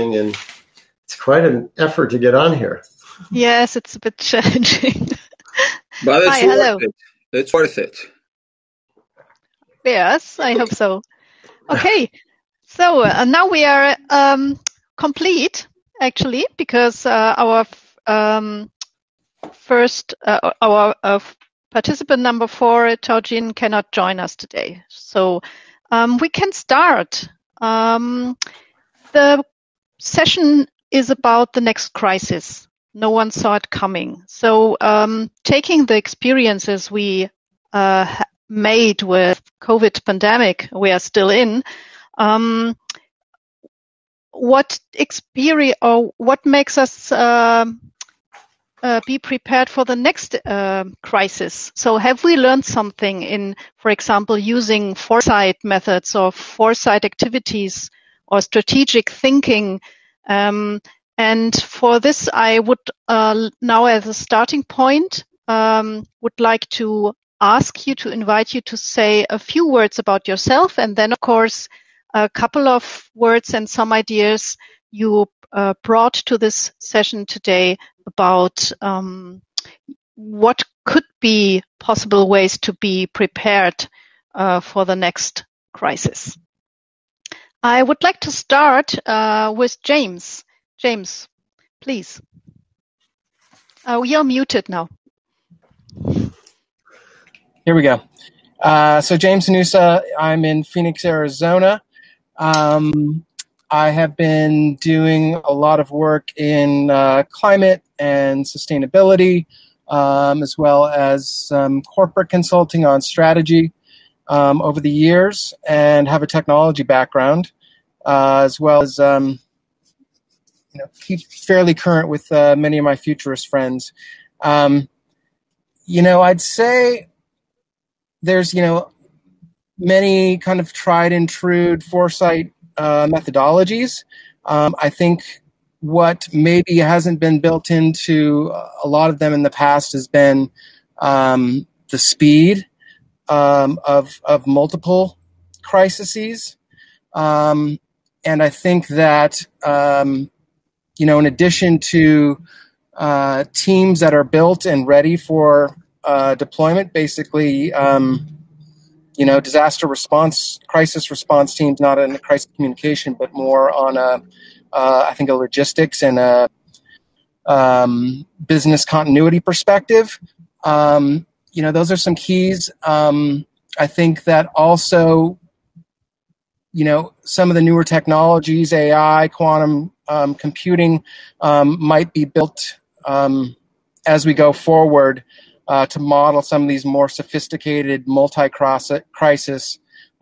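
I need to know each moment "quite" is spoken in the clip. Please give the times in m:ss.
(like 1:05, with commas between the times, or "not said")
0:01.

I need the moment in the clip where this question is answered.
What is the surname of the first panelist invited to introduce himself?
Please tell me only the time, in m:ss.
1:39.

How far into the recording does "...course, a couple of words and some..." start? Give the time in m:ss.
1:11.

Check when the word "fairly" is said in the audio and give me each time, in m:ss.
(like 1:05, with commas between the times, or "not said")
2:01.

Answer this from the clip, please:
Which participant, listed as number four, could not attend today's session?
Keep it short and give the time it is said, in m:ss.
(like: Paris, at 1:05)
Georgine, at 0:23.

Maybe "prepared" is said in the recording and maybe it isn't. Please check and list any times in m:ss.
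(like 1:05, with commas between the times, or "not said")
0:49, 1:23.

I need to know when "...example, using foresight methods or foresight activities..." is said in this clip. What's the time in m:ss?
0:53.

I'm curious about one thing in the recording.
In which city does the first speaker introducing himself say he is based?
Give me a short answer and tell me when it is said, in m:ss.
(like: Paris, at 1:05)
Phoenix, Arizona, at 1:40.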